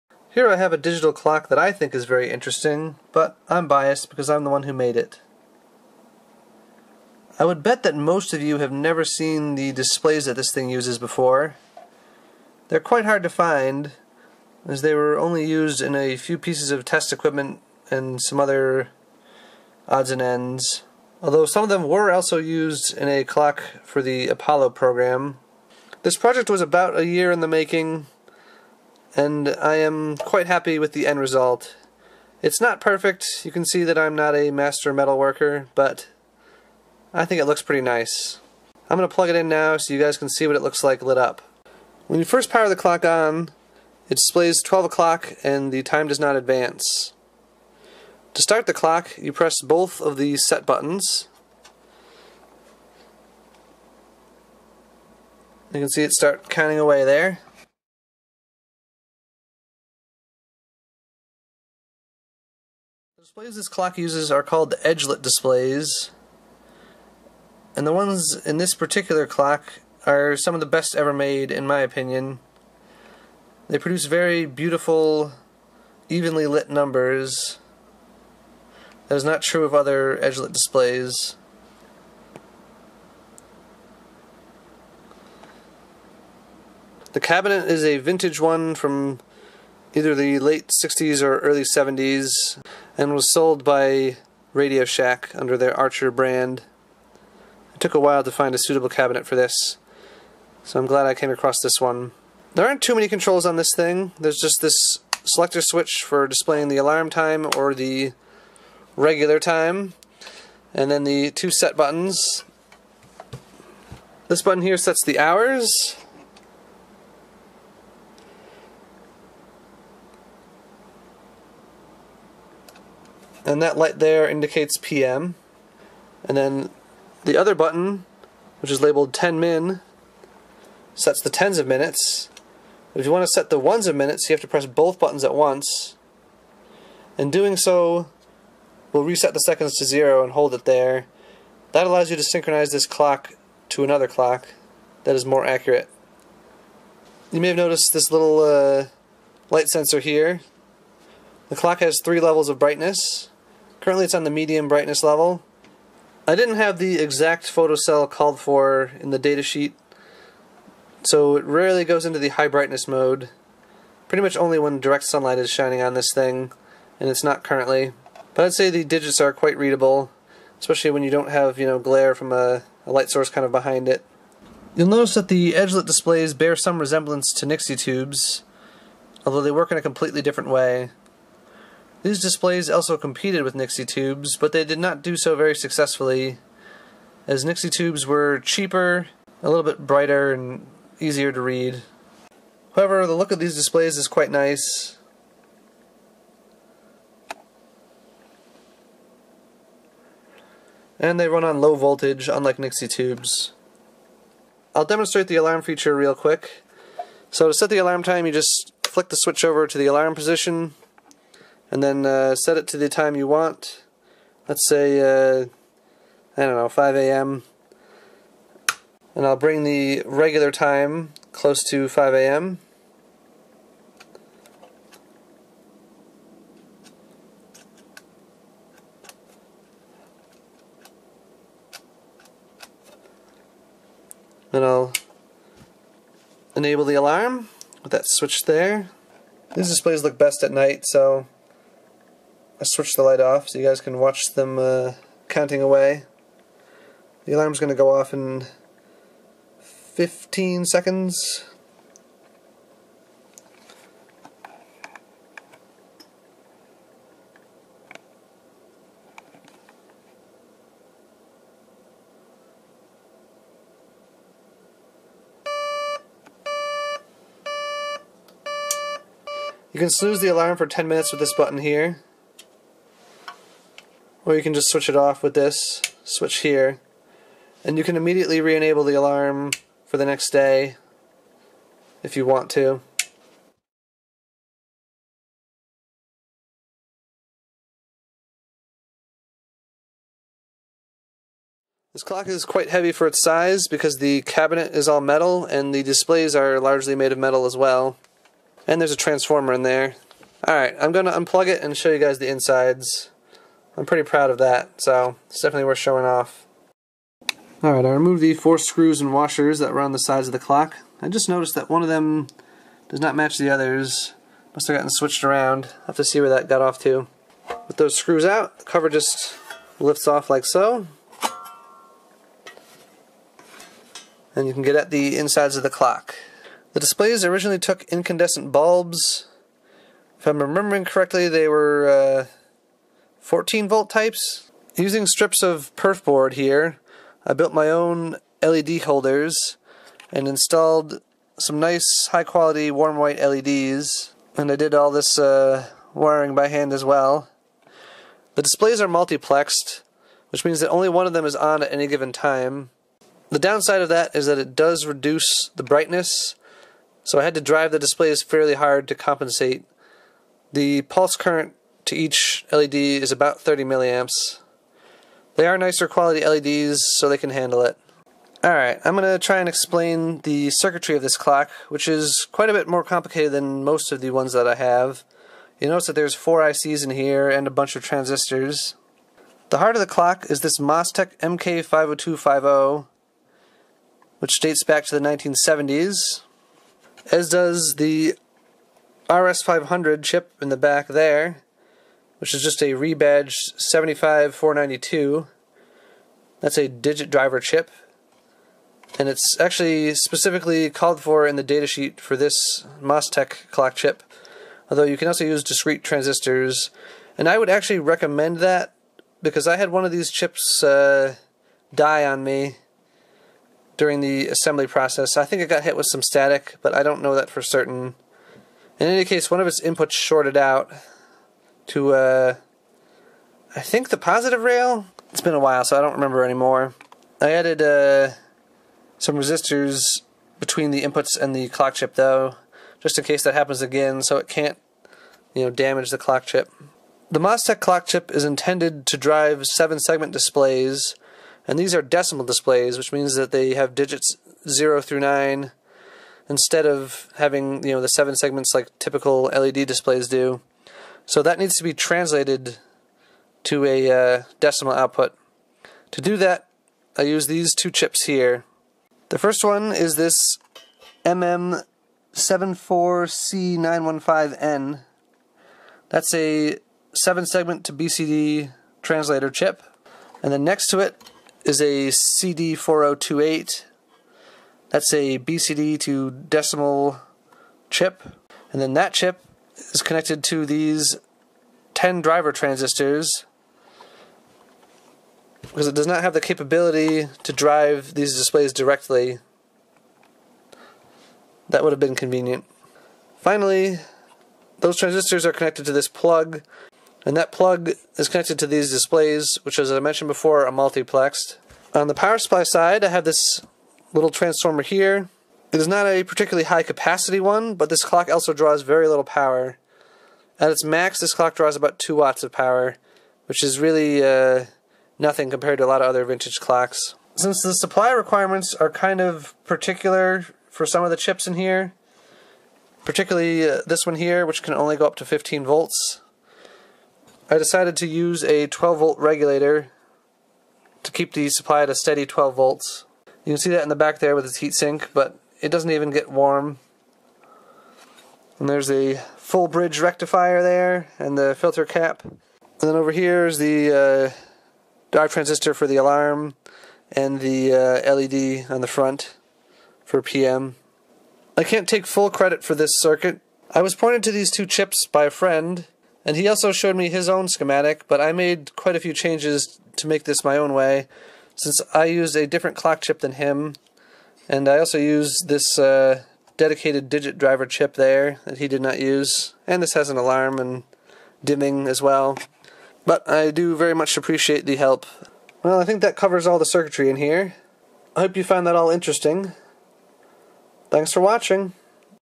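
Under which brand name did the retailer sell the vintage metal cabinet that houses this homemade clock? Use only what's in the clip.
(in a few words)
Archer.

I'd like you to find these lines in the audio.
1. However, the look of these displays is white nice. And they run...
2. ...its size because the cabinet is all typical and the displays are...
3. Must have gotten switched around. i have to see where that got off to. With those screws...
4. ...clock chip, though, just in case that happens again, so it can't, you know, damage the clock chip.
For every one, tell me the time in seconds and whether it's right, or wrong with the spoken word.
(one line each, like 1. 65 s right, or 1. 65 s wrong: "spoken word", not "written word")
1. 192 s wrong: "quite", not "white"
2. 293 s wrong: "metal", not "typical"
3. 314 s right
4. 431 s right.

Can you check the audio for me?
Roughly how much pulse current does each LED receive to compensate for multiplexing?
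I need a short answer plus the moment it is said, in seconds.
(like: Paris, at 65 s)
30 milliamps, at 363 s.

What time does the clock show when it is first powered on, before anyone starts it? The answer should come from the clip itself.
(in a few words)
12 o'clock.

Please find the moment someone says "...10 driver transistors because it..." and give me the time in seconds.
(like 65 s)
481 s.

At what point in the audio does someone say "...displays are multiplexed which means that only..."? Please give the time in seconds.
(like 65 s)
348 s.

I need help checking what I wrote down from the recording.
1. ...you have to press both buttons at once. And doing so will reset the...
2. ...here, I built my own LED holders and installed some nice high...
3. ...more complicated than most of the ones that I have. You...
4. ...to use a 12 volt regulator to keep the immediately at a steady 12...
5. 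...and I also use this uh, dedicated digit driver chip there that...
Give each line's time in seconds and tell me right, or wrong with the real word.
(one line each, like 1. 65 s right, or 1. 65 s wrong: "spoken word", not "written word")
1. 134 s right
2. 336 s right
3. 372 s right
4. 527 s wrong: "supply", not "immediately"
5. 564 s right.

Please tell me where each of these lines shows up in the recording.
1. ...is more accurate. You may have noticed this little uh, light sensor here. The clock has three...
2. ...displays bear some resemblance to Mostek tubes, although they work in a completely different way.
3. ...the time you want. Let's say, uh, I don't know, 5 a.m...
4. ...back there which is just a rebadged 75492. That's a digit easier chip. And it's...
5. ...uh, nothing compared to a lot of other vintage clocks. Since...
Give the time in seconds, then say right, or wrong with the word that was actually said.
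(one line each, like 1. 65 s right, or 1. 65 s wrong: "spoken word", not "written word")
1. 145 s right
2. 175 s wrong: "Nixie", not "Mostek"
3. 212 s right
4. 390 s wrong: "driver", not "easier"
5. 514 s right.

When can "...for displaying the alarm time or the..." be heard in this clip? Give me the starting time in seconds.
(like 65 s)
106 s.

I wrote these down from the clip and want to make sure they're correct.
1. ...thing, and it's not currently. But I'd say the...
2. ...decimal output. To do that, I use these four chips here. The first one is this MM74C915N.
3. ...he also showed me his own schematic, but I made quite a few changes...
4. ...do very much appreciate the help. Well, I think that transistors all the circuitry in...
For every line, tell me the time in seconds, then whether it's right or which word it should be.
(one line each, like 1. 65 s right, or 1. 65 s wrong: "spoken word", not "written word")
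1. 166 s right
2. 454 s wrong: "two", not "four"
3. 556 s right
4. 573 s wrong: "covers", not "transistors".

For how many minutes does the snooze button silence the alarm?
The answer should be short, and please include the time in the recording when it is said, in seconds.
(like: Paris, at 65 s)
10 minutes, at 270 s.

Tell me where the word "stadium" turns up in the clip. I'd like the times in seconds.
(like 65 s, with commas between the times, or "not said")
not said.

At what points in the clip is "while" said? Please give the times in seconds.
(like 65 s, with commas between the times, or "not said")
97 s, 425 s.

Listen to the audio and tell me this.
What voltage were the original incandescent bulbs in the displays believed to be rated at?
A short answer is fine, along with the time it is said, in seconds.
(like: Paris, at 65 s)
14 volts, at 333 s.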